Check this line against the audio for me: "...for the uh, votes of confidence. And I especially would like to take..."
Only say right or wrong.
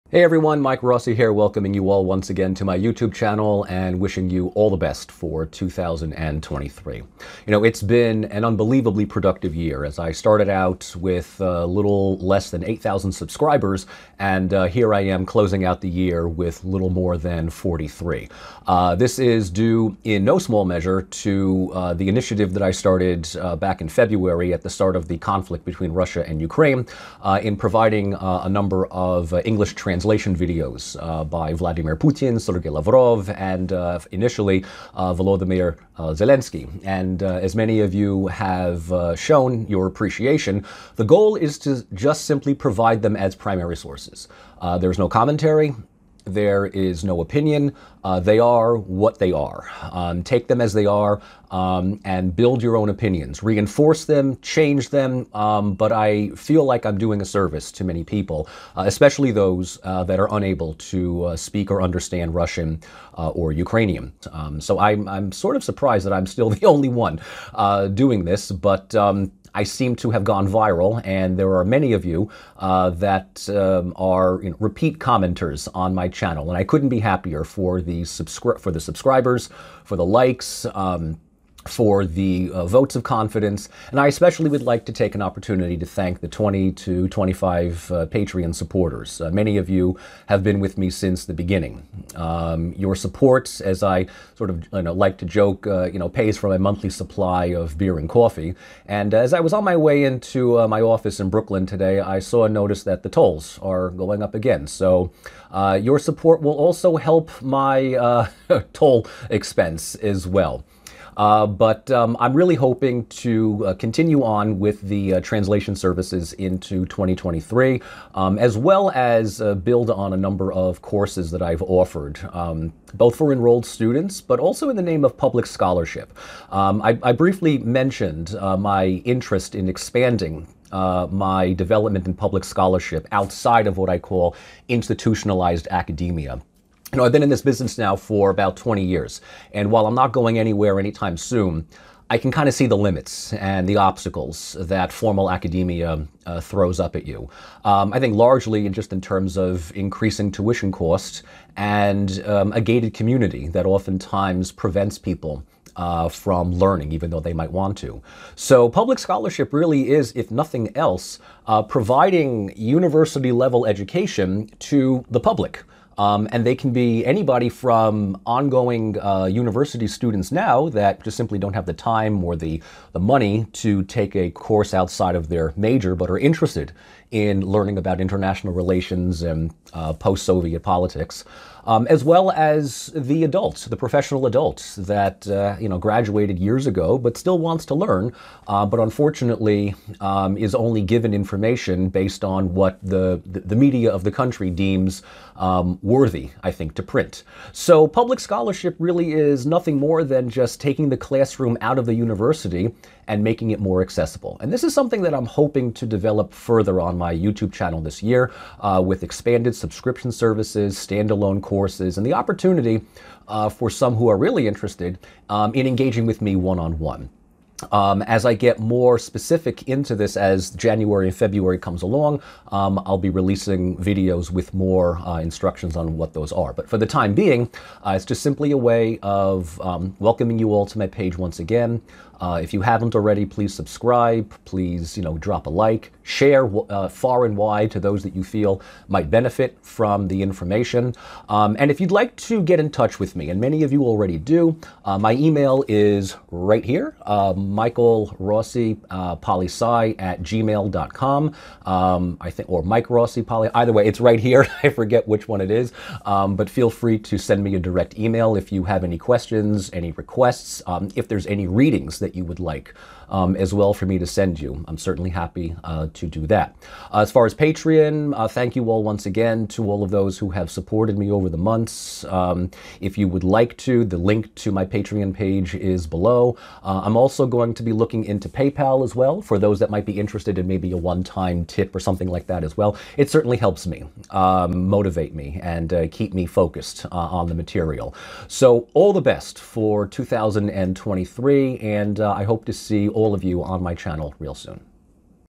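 right.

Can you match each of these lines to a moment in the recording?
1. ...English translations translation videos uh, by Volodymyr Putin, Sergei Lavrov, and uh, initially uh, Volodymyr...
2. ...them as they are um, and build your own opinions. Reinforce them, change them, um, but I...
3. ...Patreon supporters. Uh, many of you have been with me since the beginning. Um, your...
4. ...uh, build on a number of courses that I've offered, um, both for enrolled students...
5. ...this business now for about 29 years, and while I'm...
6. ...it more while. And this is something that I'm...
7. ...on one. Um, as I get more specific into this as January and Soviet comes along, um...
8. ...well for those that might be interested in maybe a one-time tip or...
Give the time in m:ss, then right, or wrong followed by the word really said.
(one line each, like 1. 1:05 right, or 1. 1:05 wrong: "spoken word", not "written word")
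1. 0:29 wrong: "Vladimir", not "Volodymyr"
2. 0:50 right
3. 1:28 right
4. 1:59 right
5. 2:17 wrong: "20", not "29"
6. 3:23 wrong: "accessible", not "while"
7. 3:36 wrong: "February", not "Soviet"
8. 4:38 right.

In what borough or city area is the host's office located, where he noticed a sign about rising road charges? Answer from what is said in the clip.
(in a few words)
Brooklyn.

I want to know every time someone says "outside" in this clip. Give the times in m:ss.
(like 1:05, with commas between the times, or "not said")
2:13, 2:54.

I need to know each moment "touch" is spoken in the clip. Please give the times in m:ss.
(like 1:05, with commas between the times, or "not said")
4:02.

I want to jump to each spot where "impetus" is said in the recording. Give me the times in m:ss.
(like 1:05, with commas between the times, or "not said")
not said.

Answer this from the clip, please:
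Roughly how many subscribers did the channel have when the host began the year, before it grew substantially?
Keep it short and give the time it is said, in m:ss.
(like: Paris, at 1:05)
8,000, at 0:12.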